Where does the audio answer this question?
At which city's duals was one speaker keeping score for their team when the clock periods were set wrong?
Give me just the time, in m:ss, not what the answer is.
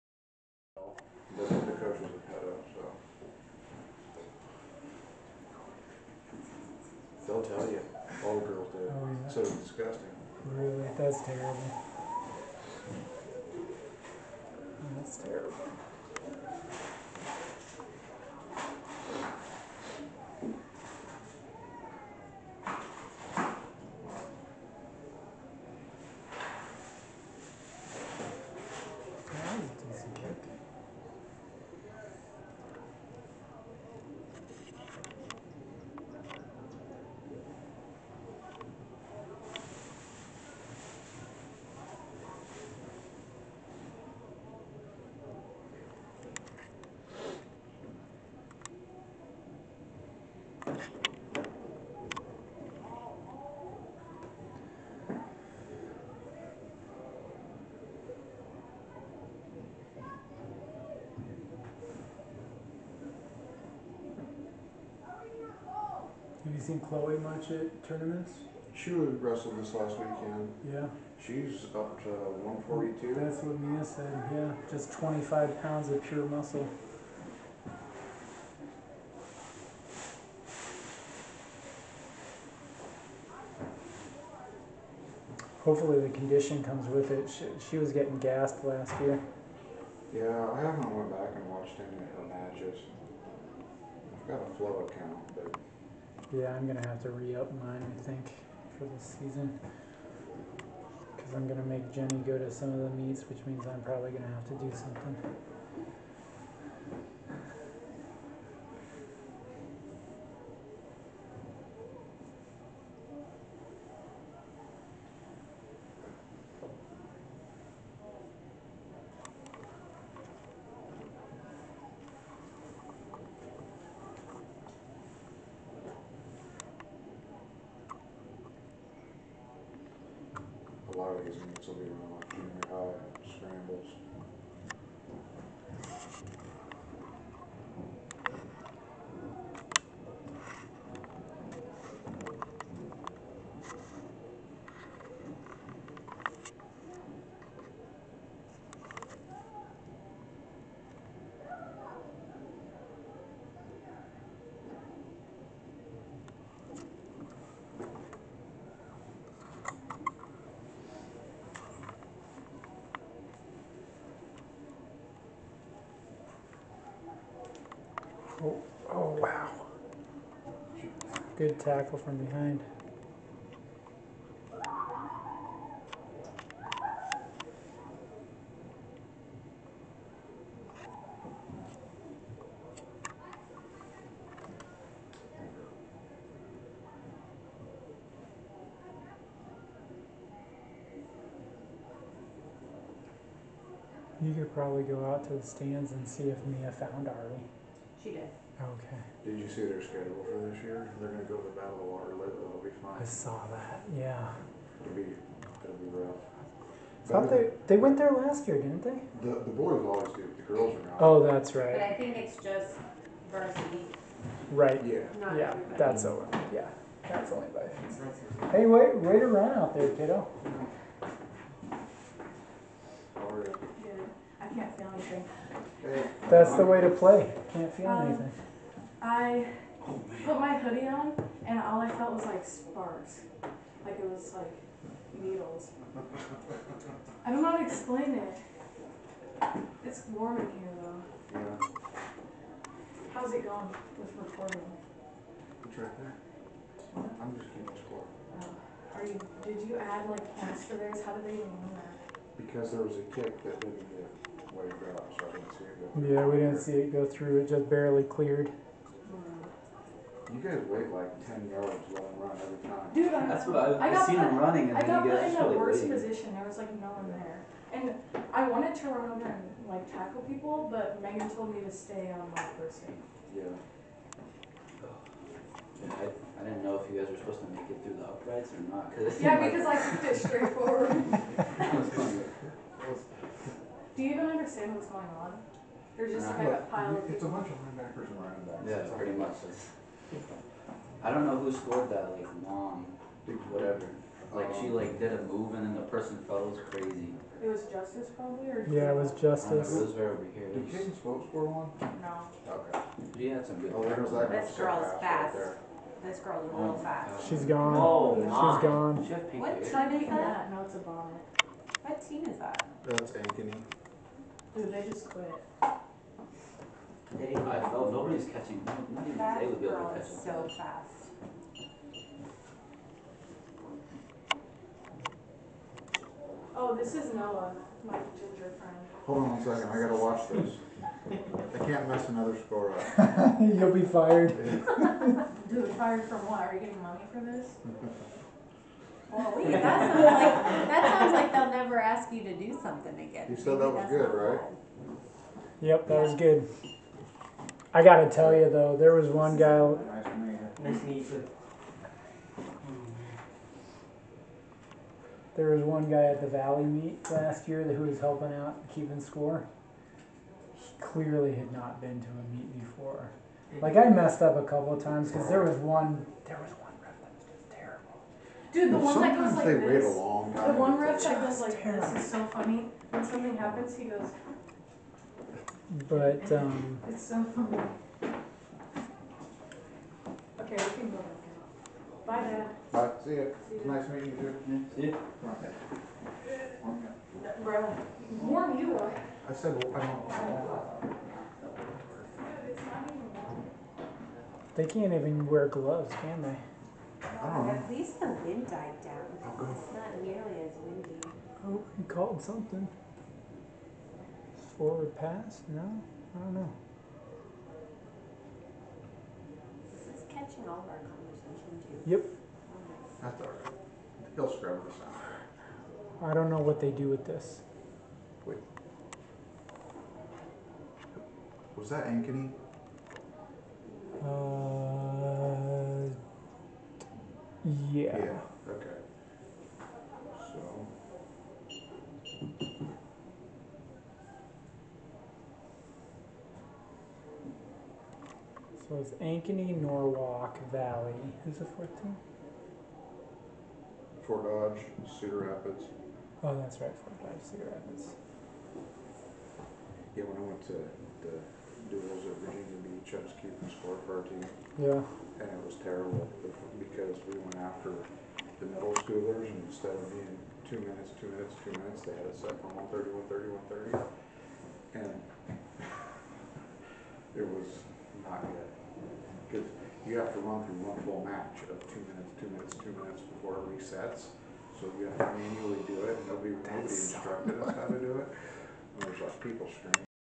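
7:32.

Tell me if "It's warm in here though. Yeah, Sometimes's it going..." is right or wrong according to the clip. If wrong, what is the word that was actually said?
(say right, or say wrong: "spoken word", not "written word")
wrong: "How", not "Sometimes".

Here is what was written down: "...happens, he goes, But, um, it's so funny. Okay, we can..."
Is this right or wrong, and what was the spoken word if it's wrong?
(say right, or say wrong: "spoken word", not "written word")
right.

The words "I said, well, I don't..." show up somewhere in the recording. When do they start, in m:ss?
6:29.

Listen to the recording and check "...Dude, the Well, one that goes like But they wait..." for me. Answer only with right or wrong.
wrong.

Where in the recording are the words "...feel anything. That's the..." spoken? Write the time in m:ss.
3:44.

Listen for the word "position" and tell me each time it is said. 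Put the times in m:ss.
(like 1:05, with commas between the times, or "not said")
4:25.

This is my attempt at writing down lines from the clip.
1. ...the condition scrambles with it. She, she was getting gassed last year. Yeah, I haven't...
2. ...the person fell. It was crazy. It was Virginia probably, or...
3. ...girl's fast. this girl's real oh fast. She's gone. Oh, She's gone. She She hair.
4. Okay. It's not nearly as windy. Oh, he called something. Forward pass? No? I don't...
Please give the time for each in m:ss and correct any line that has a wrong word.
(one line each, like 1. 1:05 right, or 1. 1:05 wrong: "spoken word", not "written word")
1. 1:26 wrong: "comes", not "scrambles"
2. 4:55 wrong: "Justice", not "Virginia"
3. 5:04 wrong: "What", not "She"
4. 6:39 right.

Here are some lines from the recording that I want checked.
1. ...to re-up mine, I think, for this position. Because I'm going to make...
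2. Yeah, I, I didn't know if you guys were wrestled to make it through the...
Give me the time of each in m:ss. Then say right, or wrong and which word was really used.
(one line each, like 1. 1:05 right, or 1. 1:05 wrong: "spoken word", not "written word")
1. 1:37 wrong: "season", not "position"
2. 4:35 wrong: "supposed", not "wrestled".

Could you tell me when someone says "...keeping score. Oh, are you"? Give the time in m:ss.
4:07.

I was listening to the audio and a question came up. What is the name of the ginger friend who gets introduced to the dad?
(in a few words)
Noah.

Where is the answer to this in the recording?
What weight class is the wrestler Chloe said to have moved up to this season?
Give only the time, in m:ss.
1:12.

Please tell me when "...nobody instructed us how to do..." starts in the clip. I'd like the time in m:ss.
7:56.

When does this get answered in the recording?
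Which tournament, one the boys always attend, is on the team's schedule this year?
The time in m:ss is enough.
3:21.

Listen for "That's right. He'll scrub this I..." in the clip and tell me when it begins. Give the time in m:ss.
6:53.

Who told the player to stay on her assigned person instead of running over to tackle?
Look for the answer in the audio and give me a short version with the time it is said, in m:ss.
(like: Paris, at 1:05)
Megan, at 4:31.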